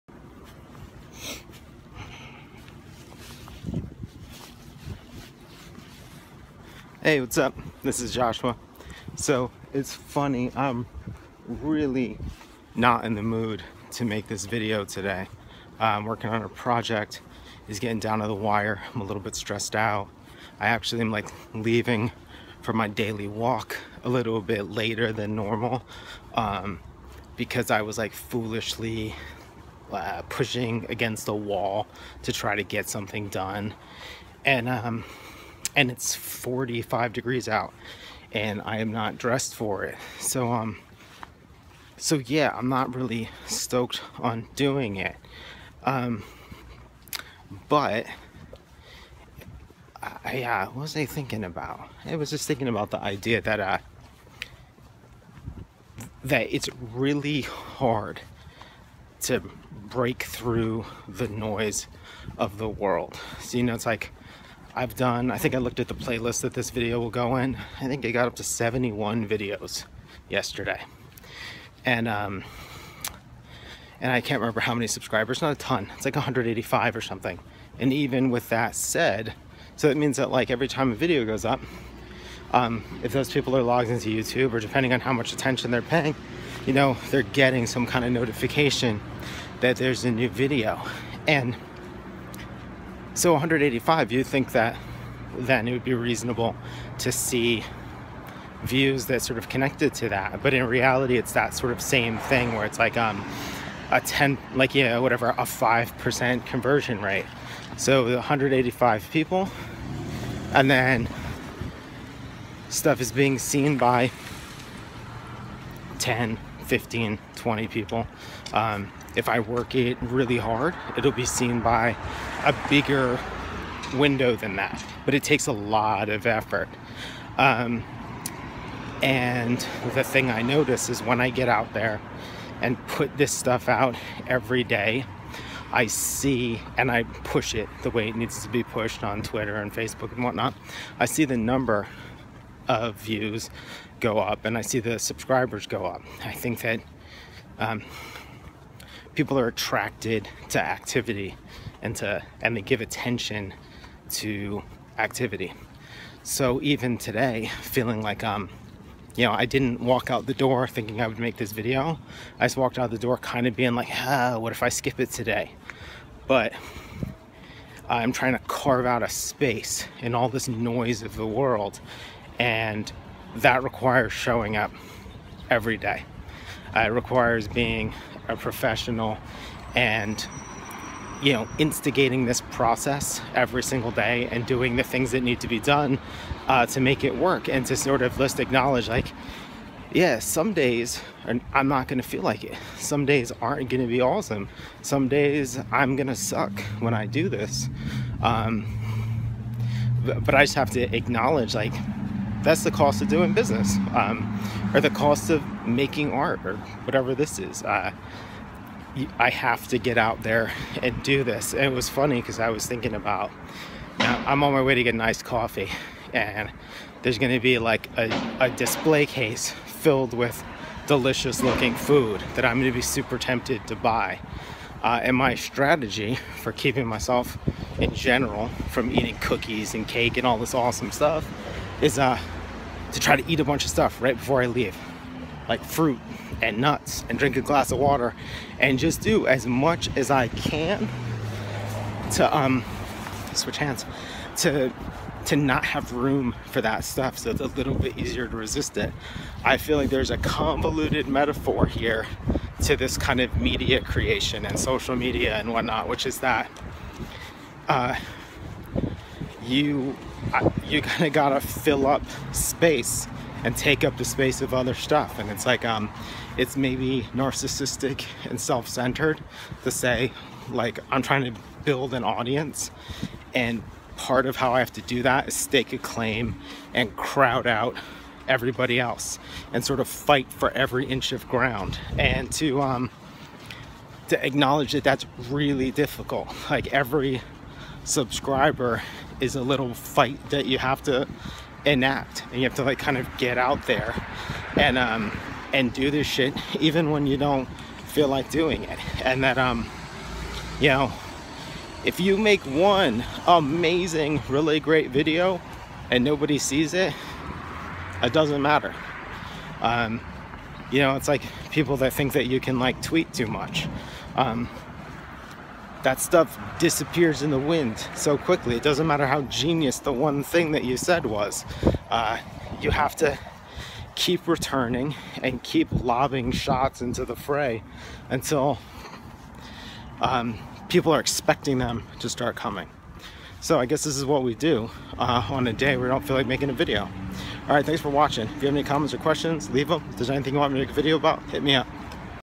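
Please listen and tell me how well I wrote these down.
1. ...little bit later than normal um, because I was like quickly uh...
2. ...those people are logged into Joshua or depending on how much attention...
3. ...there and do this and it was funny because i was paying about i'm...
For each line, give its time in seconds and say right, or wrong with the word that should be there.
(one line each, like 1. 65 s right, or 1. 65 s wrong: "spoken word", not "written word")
1. 24 s wrong: "foolishly", not "quickly"
2. 83 s wrong: "YouTube", not "Joshua"
3. 210 s wrong: "thinking", not "paying".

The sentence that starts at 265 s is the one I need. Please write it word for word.
And it's like, um, it's maybe narcissistic and self-centered to say, like, I'm trying to build an audience.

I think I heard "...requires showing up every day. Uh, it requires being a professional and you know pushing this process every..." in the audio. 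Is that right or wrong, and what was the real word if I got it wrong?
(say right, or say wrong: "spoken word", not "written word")
wrong: "instigating", not "pushing".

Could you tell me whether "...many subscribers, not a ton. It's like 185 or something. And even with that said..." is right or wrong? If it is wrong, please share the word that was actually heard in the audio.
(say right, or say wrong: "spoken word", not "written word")
right.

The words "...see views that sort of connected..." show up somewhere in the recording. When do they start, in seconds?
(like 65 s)
97 s.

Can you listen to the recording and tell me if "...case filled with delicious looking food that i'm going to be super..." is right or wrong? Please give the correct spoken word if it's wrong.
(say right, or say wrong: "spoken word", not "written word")
right.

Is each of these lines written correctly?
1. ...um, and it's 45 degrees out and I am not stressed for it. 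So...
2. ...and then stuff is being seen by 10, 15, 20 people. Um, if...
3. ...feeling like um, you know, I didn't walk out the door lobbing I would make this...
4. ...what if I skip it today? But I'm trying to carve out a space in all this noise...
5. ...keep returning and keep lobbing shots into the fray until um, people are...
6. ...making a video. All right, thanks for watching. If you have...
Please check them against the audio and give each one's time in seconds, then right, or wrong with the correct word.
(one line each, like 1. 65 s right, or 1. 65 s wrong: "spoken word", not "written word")
1. 34 s wrong: "dressed", not "stressed"
2. 110 s right
3. 157 s wrong: "thinking", not "lobbing"
4. 164 s right
5. 323 s right
6. 336 s right.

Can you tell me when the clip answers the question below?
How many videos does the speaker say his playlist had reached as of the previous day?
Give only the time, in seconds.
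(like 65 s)
68 s.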